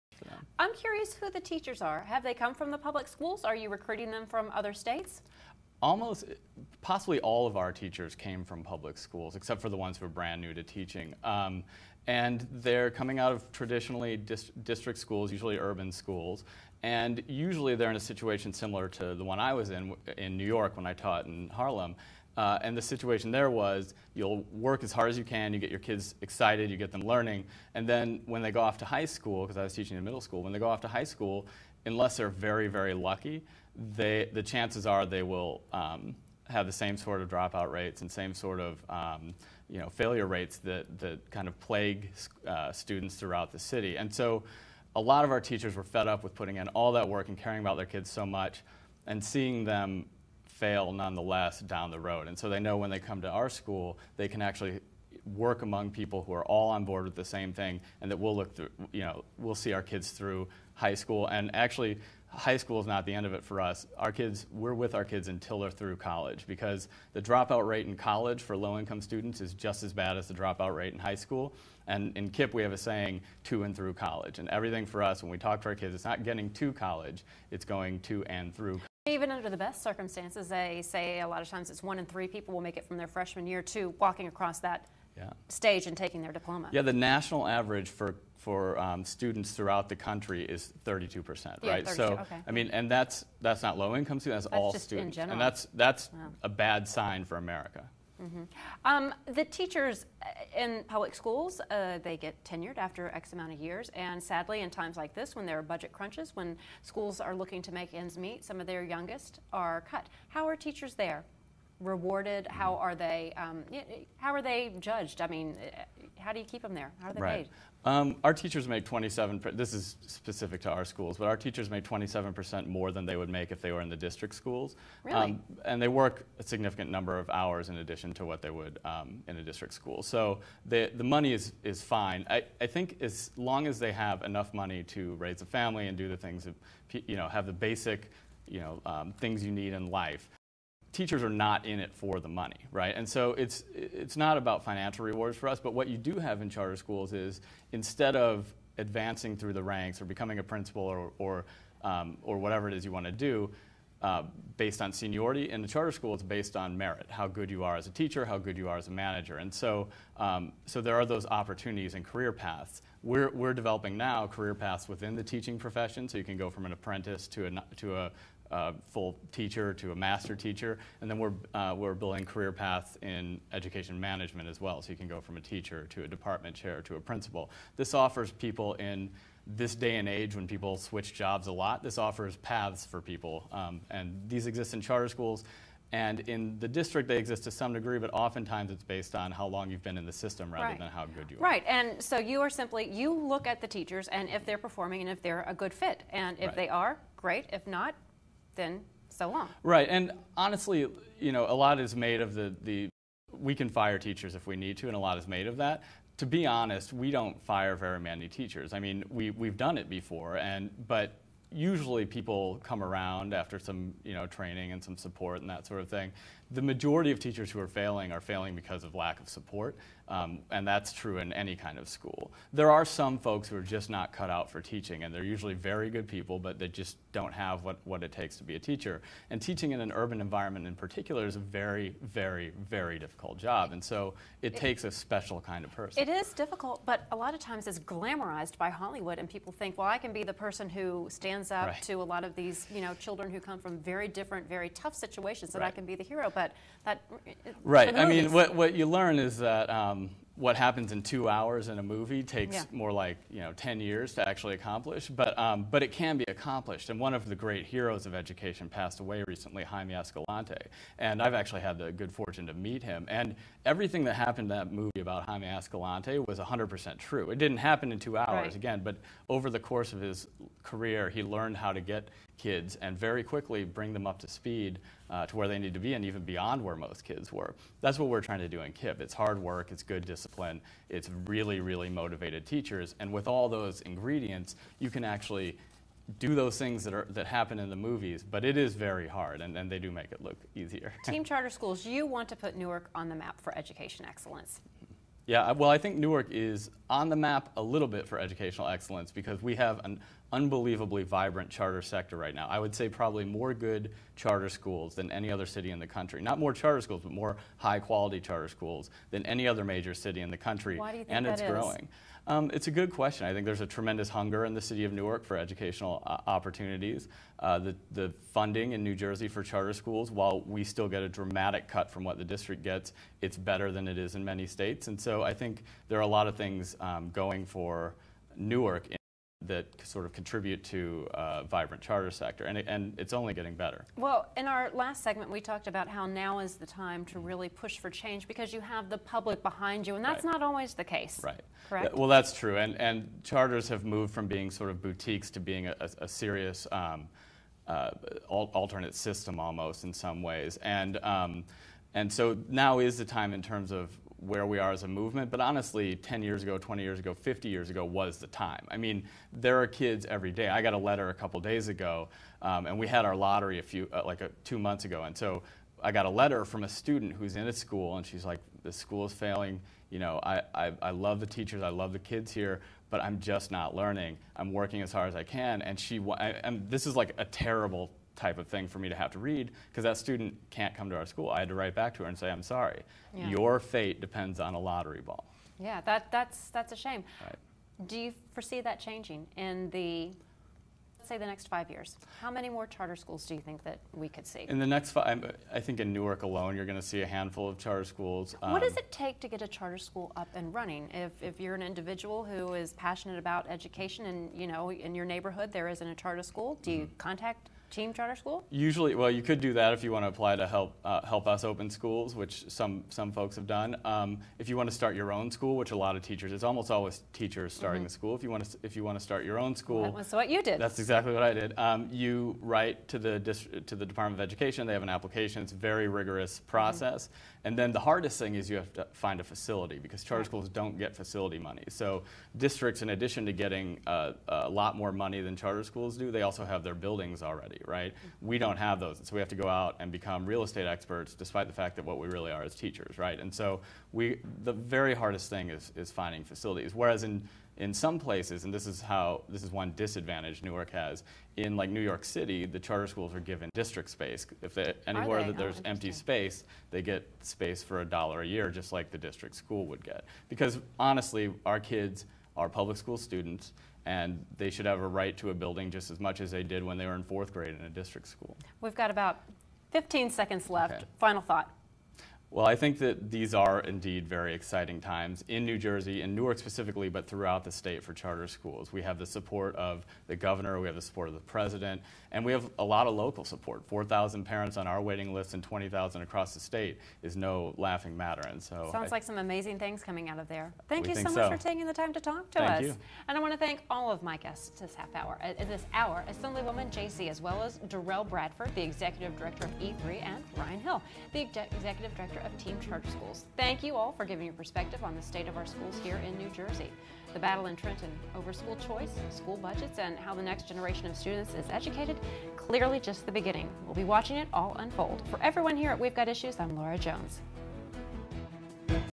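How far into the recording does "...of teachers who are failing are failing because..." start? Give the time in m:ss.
3:37.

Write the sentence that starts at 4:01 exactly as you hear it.
to a lot of these you know, children who come from very different, very tough situations, and right.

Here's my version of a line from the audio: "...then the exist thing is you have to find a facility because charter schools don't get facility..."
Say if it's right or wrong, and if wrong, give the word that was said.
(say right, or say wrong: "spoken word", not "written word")
wrong: "hardest", not "exist".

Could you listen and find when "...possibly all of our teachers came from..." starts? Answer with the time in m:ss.
0:06.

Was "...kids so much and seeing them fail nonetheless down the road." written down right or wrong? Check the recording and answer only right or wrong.
right.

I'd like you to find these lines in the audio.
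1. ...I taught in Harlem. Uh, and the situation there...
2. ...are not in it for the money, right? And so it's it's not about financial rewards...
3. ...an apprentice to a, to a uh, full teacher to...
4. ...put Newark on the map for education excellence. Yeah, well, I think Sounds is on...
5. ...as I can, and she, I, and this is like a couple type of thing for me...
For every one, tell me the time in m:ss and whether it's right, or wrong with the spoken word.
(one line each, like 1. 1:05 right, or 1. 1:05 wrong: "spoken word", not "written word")
1. 0:20 right
2. 2:21 right
3. 2:46 right
4. 4:52 wrong: "Newark", not "Sounds"
5. 6:15 wrong: "terrible", not "couple".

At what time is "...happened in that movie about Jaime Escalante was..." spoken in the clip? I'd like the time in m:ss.
4:24.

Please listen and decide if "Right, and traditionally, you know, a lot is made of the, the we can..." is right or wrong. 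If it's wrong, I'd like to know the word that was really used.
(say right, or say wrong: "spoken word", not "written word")
wrong: "honestly", not "traditionally".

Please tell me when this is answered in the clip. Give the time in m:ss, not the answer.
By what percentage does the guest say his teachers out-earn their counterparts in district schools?
2:01.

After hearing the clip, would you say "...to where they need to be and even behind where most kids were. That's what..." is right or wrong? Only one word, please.
wrong.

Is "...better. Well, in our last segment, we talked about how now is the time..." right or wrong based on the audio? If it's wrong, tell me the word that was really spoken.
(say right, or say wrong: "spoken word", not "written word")
right.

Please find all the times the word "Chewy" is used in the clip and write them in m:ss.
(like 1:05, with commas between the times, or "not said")
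not said.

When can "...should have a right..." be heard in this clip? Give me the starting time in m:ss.
7:44.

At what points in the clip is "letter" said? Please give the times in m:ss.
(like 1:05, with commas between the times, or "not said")
6:00, 6:06.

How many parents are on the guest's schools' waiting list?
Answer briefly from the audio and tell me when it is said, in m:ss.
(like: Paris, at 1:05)
4,000, at 8:03.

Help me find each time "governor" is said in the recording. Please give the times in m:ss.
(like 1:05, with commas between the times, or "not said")
8:00.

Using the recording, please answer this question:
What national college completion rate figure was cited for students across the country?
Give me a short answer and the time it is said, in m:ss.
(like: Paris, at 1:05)
32 percent, at 1:30.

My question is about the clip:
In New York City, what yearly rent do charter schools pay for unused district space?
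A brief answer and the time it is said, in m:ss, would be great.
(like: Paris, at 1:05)
a dollar, at 7:37.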